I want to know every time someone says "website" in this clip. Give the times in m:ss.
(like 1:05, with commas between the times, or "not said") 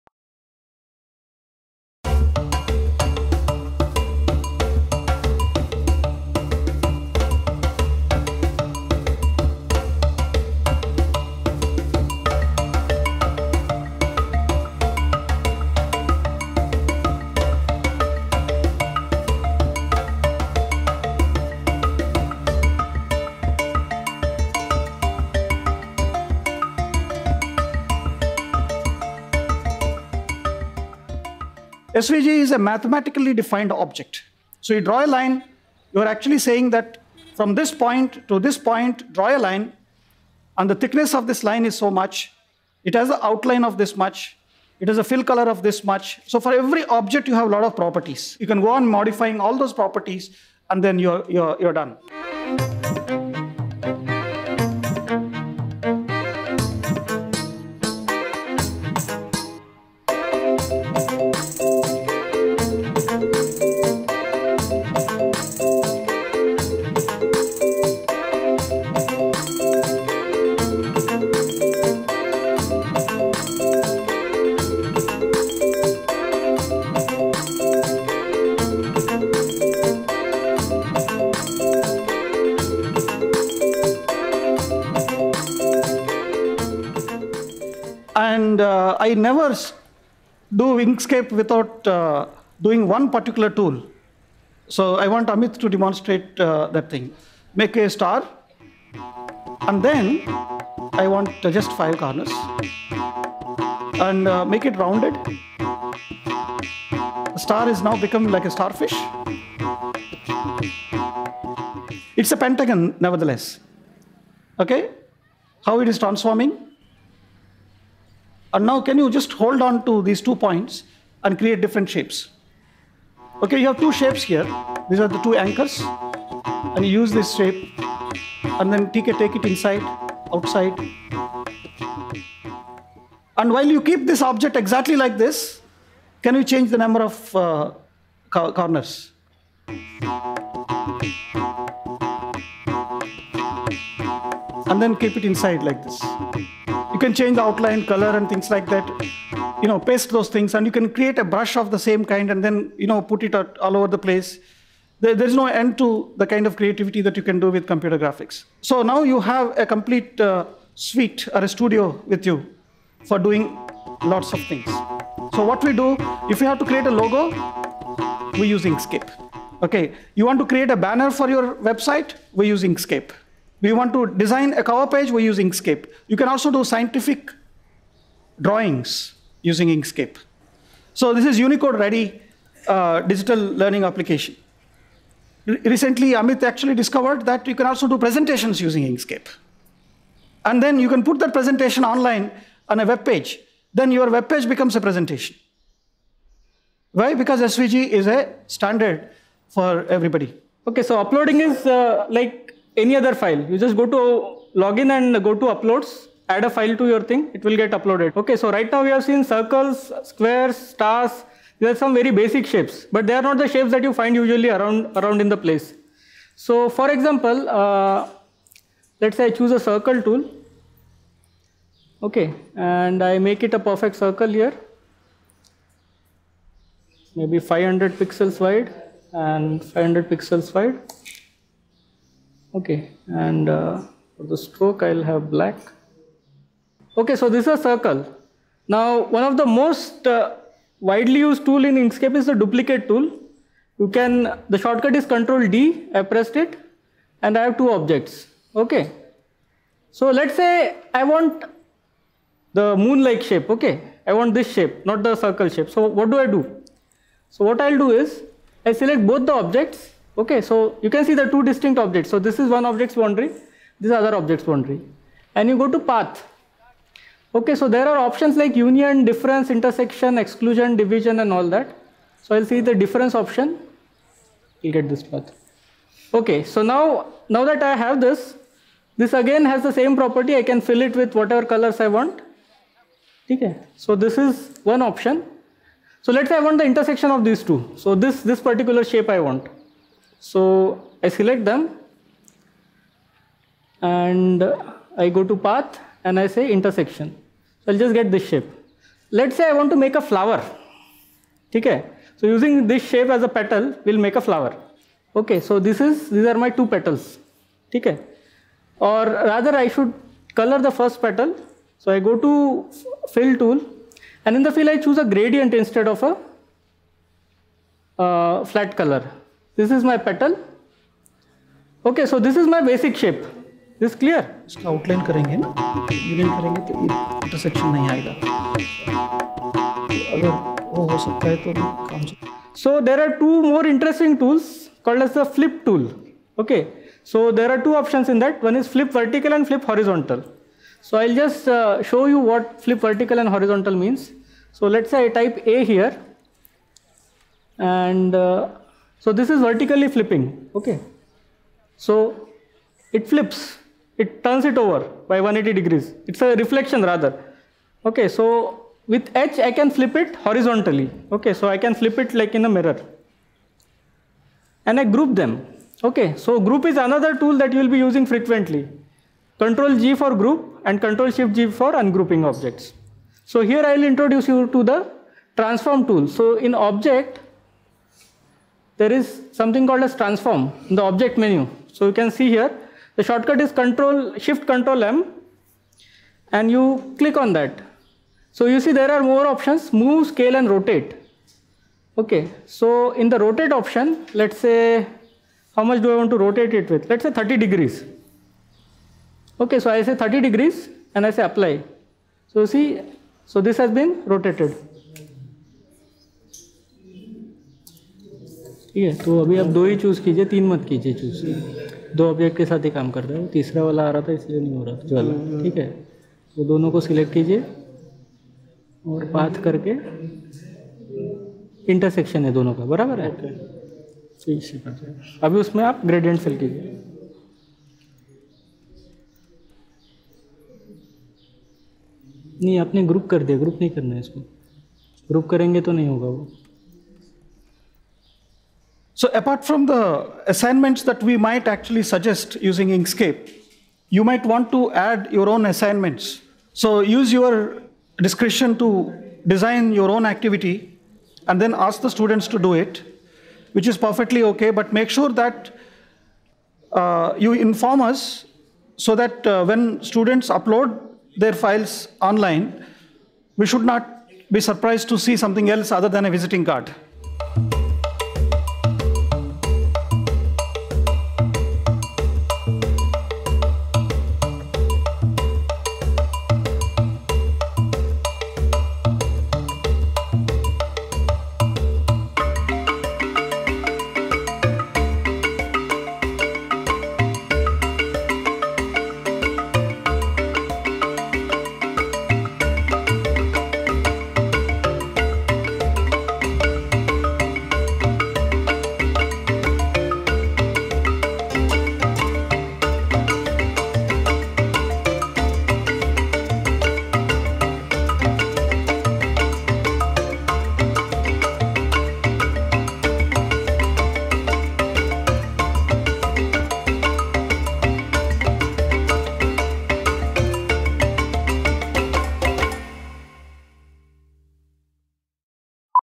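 2:51.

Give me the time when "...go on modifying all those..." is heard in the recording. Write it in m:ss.
0:48.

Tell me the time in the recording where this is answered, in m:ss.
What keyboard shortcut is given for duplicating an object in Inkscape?
4:05.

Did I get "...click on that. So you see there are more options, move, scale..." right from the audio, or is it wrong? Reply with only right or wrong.
right.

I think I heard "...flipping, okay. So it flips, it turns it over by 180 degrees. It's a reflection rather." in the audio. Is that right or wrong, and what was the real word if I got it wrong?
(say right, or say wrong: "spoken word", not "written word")
right.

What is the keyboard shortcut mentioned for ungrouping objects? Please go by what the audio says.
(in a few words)
Control Shift G.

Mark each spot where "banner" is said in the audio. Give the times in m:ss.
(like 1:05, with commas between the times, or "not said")
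2:50.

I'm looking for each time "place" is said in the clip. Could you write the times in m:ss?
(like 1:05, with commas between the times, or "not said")
2:33, 3:35.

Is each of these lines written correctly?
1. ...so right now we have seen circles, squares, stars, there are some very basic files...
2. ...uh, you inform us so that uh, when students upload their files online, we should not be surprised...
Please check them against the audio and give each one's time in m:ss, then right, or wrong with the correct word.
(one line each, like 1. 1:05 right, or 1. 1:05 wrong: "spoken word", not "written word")
1. 3:28 wrong: "shapes", not "files"
2. 7:36 right.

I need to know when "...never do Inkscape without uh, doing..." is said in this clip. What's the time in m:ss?
1:29.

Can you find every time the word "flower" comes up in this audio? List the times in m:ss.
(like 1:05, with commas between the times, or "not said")
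5:00, 5:04.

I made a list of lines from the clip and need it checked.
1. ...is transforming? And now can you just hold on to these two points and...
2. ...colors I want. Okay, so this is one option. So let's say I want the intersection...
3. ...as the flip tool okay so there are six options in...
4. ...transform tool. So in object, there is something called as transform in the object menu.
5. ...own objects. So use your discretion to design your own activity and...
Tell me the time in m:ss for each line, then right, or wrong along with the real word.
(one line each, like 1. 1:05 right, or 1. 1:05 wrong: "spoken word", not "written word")
1. 1:55 right
2. 4:41 right
3. 5:35 wrong: "two", not "six"
4. 6:15 right
5. 7:25 wrong: "assignments", not "objects".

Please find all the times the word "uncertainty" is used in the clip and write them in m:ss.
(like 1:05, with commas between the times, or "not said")
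not said.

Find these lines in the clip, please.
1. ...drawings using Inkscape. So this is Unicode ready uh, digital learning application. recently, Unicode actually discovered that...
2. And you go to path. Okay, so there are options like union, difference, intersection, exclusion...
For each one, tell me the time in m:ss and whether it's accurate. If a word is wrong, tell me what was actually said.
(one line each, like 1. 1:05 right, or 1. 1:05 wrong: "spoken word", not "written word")
1. 2:58 wrong: "Amit", not "Unicode"
2. 4:25 right.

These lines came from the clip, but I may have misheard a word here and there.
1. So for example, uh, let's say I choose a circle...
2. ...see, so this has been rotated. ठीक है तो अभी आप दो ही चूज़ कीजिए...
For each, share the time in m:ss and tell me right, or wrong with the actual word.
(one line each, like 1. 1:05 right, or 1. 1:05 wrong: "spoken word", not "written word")
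1. 3:36 right
2. 6:42 right.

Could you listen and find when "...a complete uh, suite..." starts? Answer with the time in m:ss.
2:39.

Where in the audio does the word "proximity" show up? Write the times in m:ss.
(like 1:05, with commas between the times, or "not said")
not said.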